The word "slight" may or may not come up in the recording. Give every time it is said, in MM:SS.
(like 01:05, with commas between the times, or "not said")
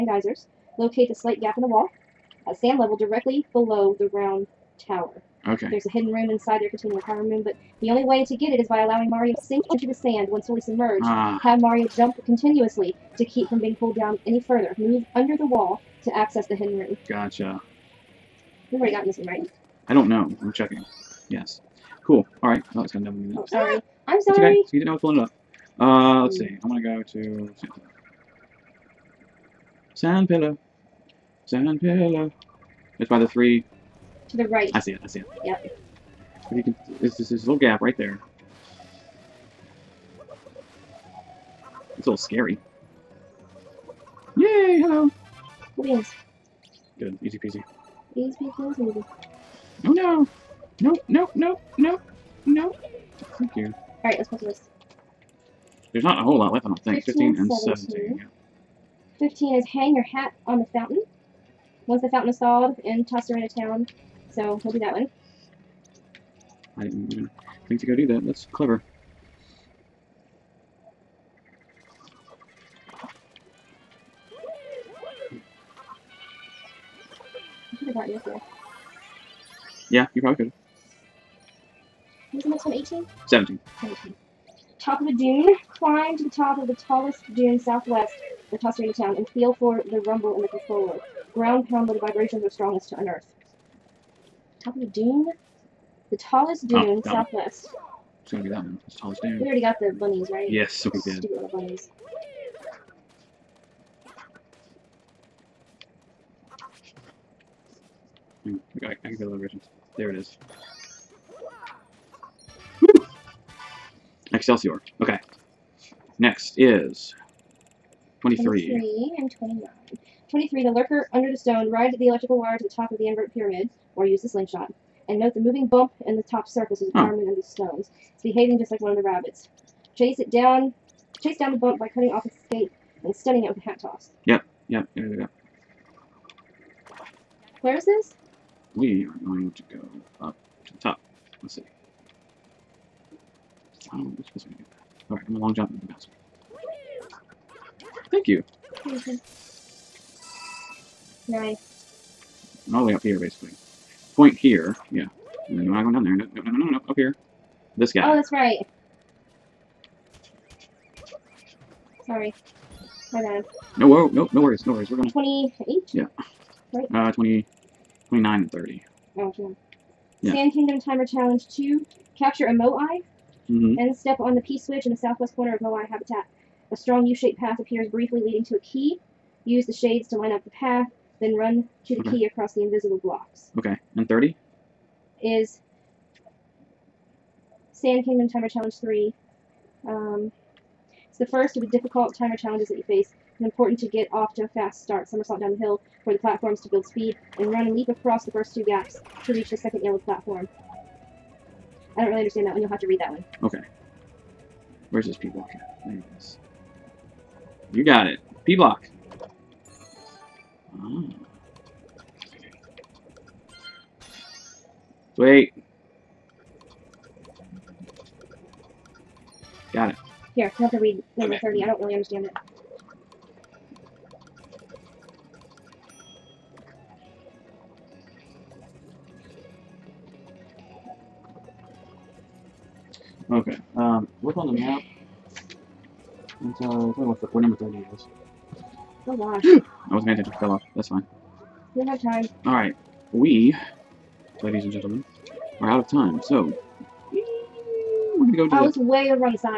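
00:01.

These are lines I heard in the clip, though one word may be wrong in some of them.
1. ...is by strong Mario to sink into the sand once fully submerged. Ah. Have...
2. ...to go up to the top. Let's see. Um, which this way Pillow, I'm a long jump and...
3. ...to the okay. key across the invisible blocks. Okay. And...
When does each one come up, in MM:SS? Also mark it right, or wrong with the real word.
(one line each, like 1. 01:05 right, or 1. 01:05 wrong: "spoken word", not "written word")
1. 00:08 wrong: "allowing", not "strong"
2. 02:19 wrong: "Alright", not "Pillow"
3. 03:01 right.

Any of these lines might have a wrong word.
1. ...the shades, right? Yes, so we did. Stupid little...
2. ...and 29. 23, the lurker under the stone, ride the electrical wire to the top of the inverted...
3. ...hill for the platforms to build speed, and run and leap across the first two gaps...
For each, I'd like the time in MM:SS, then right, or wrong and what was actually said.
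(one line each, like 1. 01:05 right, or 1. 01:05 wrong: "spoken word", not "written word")
1. 01:39 wrong: "bunnies", not "shades"
2. 01:59 right
3. 03:15 right.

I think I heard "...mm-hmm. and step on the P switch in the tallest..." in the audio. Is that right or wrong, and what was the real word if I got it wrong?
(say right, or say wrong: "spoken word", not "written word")
wrong: "southwest", not "tallest".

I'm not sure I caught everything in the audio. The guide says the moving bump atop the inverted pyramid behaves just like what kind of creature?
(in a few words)
one of the rabbits.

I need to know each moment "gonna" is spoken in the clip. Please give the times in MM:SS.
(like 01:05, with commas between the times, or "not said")
00:22, 01:38, 02:44.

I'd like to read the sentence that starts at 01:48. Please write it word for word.
look, hmm, I, I can feel the vibrations.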